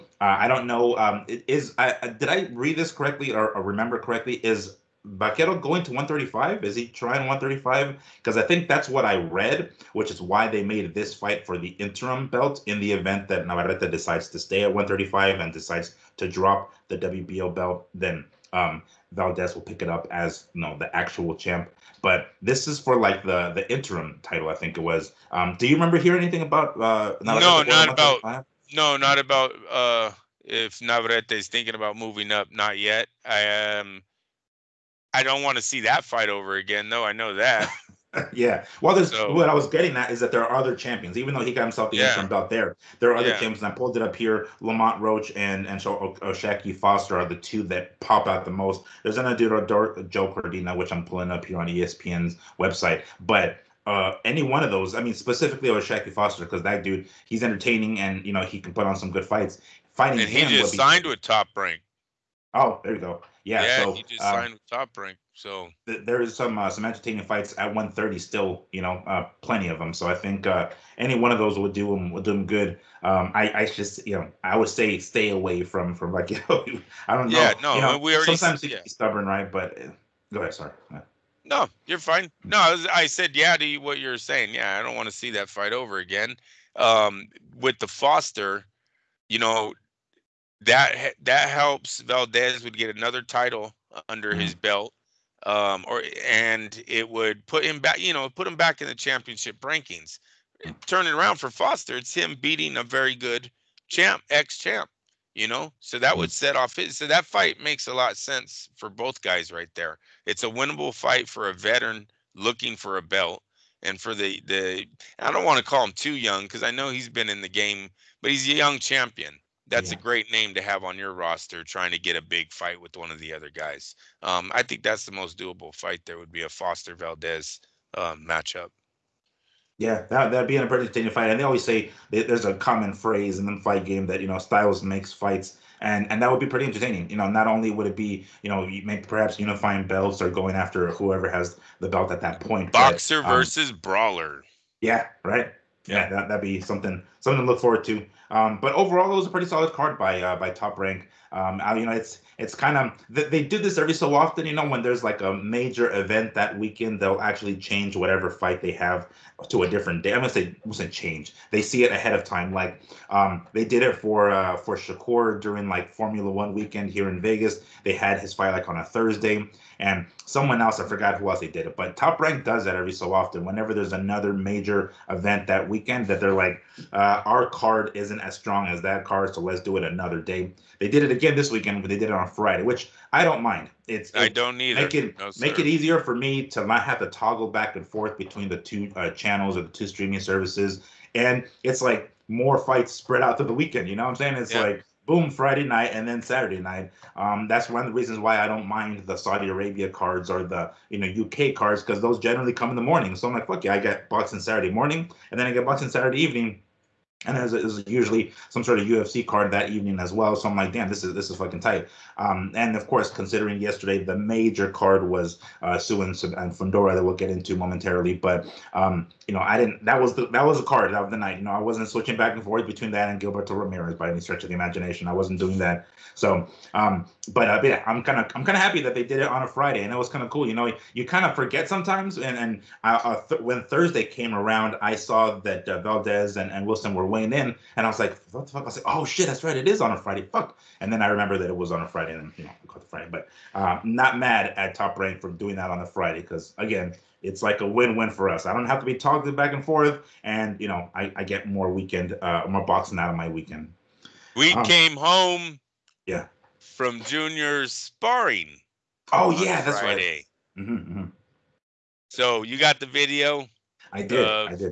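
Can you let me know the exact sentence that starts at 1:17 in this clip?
Yeah, no, you know, we already sometimes he's yeah.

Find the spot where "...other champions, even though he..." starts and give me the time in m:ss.
0:40.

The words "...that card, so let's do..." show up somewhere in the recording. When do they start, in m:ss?
2:58.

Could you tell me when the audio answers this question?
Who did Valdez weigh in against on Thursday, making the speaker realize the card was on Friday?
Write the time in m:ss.
3:56.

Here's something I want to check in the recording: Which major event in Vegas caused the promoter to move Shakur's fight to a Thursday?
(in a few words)
Formula One.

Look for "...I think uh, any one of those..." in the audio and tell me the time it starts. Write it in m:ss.
1:10.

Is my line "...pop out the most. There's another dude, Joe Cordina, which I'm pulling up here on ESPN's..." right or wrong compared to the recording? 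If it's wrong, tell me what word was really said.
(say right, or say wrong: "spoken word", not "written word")
right.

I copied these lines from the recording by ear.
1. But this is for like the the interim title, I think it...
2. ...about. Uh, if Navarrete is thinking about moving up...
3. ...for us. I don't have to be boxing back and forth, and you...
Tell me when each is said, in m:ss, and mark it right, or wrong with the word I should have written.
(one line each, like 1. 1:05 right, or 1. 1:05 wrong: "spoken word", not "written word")
1. 0:22 right
2. 0:29 right
3. 4:08 wrong: "toggling", not "boxing".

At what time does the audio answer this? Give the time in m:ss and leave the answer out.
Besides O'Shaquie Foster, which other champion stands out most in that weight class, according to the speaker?
0:44.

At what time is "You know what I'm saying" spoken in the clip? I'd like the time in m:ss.
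3:13.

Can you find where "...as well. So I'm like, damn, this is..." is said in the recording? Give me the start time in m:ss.
3:29.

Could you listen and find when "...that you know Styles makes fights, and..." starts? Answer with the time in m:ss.
2:14.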